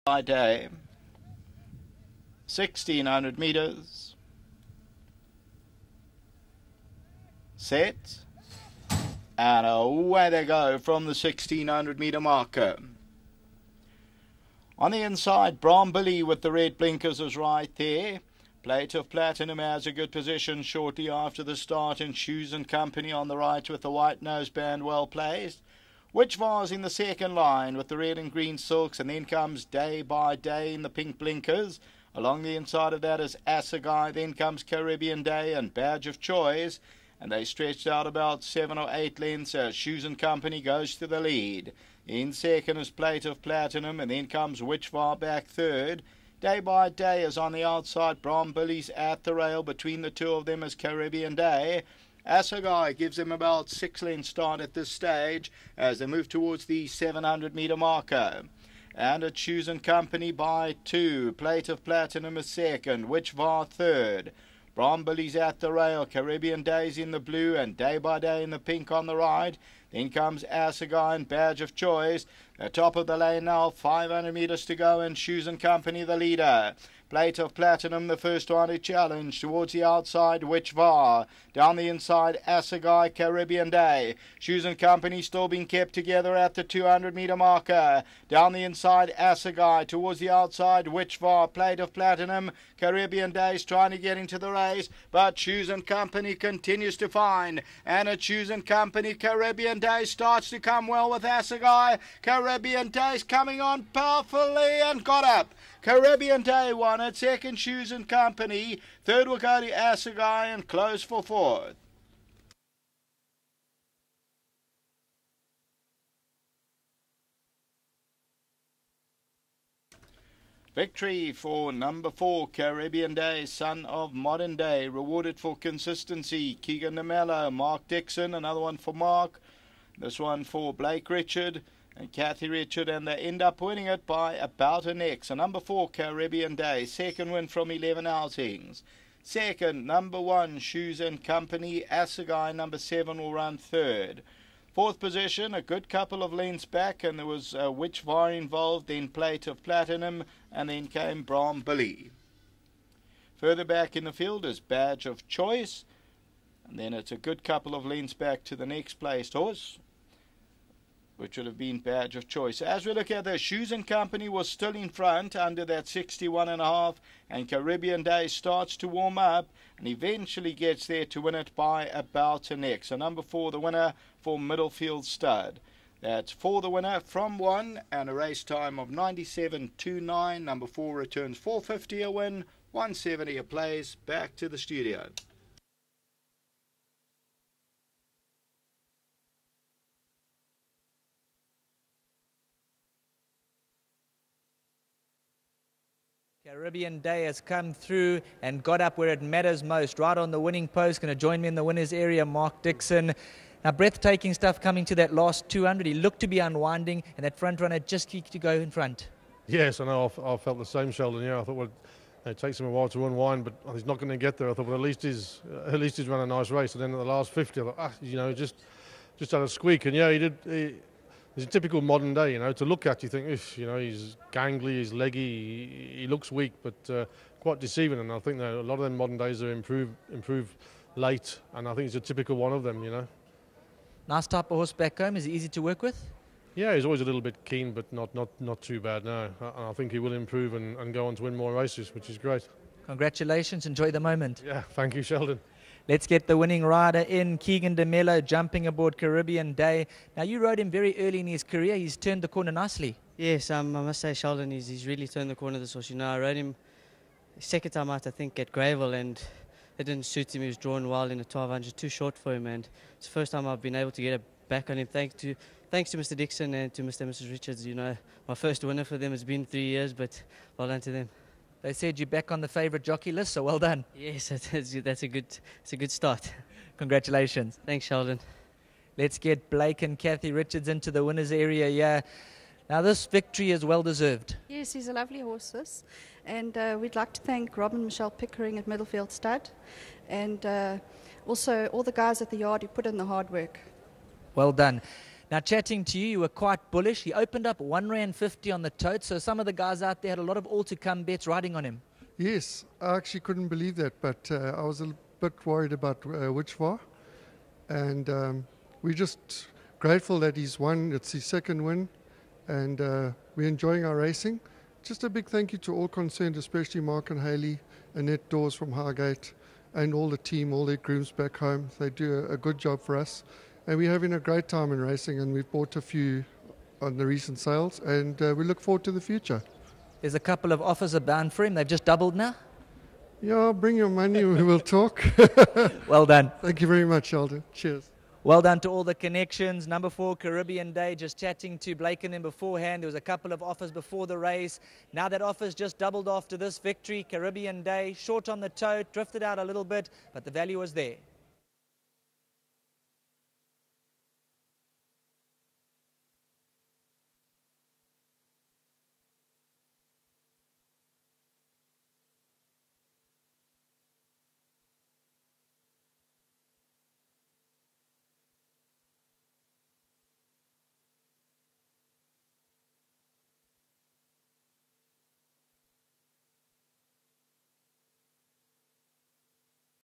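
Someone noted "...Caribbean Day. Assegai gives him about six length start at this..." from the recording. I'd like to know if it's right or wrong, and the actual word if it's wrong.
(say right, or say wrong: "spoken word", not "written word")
right.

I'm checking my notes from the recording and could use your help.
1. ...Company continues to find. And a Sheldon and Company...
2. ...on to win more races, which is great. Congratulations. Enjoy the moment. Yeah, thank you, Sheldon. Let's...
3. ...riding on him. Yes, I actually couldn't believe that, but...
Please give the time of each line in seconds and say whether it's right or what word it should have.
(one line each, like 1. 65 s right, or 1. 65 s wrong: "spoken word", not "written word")
1. 95 s wrong: "Shoes", not "Sheldon"
2. 241 s right
3. 301 s right.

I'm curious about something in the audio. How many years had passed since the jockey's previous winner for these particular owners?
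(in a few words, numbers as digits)
3 years.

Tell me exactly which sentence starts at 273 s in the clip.
Yes, that's, that's a good, that's a good start.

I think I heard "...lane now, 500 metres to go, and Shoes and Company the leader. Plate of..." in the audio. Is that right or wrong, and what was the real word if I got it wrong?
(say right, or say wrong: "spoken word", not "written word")
right.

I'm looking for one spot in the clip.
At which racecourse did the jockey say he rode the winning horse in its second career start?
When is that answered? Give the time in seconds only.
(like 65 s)
258 s.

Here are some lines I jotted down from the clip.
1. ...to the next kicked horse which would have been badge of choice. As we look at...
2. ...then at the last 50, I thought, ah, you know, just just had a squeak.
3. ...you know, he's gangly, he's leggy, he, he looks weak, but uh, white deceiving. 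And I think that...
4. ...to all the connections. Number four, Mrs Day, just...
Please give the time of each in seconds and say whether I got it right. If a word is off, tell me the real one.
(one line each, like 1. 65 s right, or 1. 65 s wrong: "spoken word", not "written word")
1. 158 s wrong: "placed", not "kicked"
2. 216 s right
3. 223 s wrong: "quite", not "white"
4. 338 s wrong: "Caribbean", not "Mrs".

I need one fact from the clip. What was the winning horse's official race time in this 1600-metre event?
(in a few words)
97.29.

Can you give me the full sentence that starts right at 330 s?
There's a couple of offers abound for him.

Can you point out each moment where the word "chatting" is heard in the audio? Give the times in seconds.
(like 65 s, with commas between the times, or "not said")
295 s, 341 s.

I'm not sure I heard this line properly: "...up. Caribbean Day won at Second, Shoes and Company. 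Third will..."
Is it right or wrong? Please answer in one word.
right.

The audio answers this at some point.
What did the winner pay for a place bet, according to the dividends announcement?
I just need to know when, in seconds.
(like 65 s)
182 s.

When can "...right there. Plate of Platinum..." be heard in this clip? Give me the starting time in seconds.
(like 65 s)
17 s.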